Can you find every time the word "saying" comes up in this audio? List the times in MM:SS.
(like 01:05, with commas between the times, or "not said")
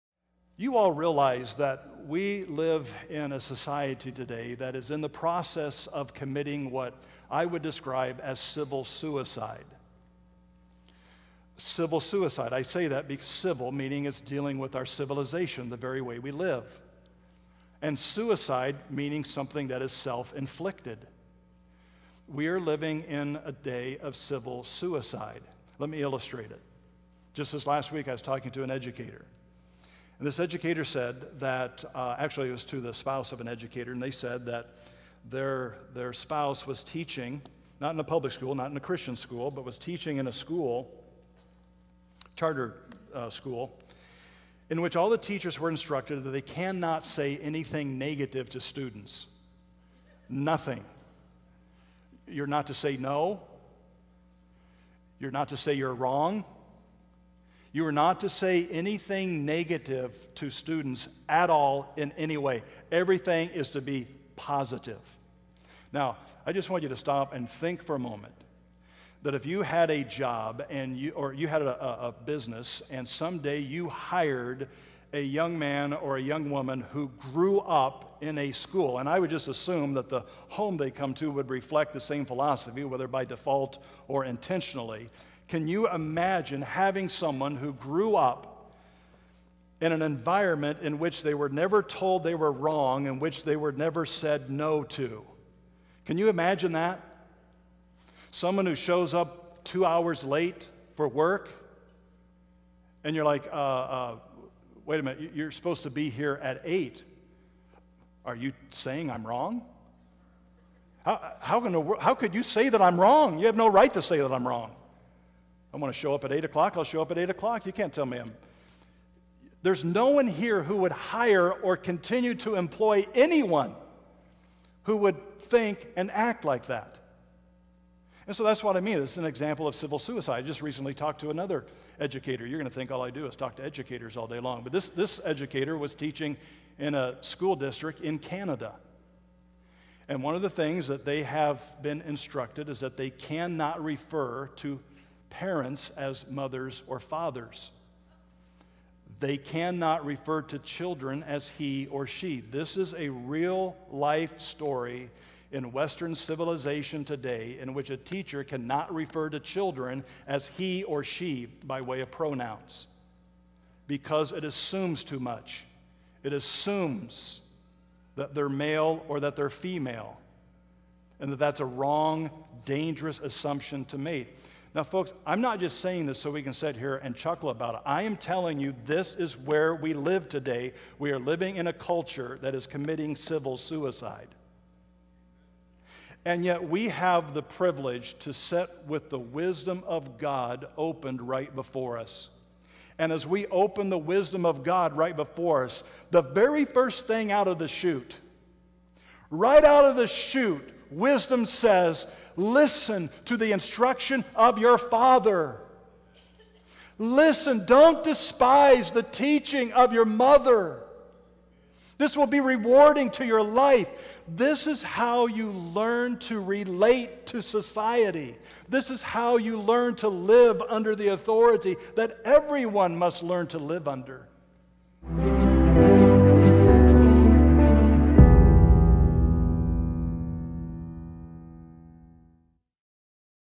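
01:48, 02:55.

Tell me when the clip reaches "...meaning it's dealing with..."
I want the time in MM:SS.
00:13.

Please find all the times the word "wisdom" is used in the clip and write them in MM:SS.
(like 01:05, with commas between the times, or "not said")
03:09, 03:13, 03:20.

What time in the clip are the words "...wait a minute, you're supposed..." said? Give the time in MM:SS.
01:44.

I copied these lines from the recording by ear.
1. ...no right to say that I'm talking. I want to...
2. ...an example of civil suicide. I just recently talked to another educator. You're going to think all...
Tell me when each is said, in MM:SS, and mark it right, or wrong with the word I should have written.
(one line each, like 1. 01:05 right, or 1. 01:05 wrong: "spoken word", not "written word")
1. 01:53 wrong: "wrong", not "talking"
2. 02:09 right.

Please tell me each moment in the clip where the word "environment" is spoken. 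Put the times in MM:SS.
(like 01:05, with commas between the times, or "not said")
01:30.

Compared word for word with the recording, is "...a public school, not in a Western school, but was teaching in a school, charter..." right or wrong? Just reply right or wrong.
wrong.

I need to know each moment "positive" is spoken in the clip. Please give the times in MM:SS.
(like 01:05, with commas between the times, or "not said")
01:04.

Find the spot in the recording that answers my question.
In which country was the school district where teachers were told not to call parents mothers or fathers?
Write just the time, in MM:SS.
02:18.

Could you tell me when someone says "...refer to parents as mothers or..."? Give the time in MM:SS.
02:23.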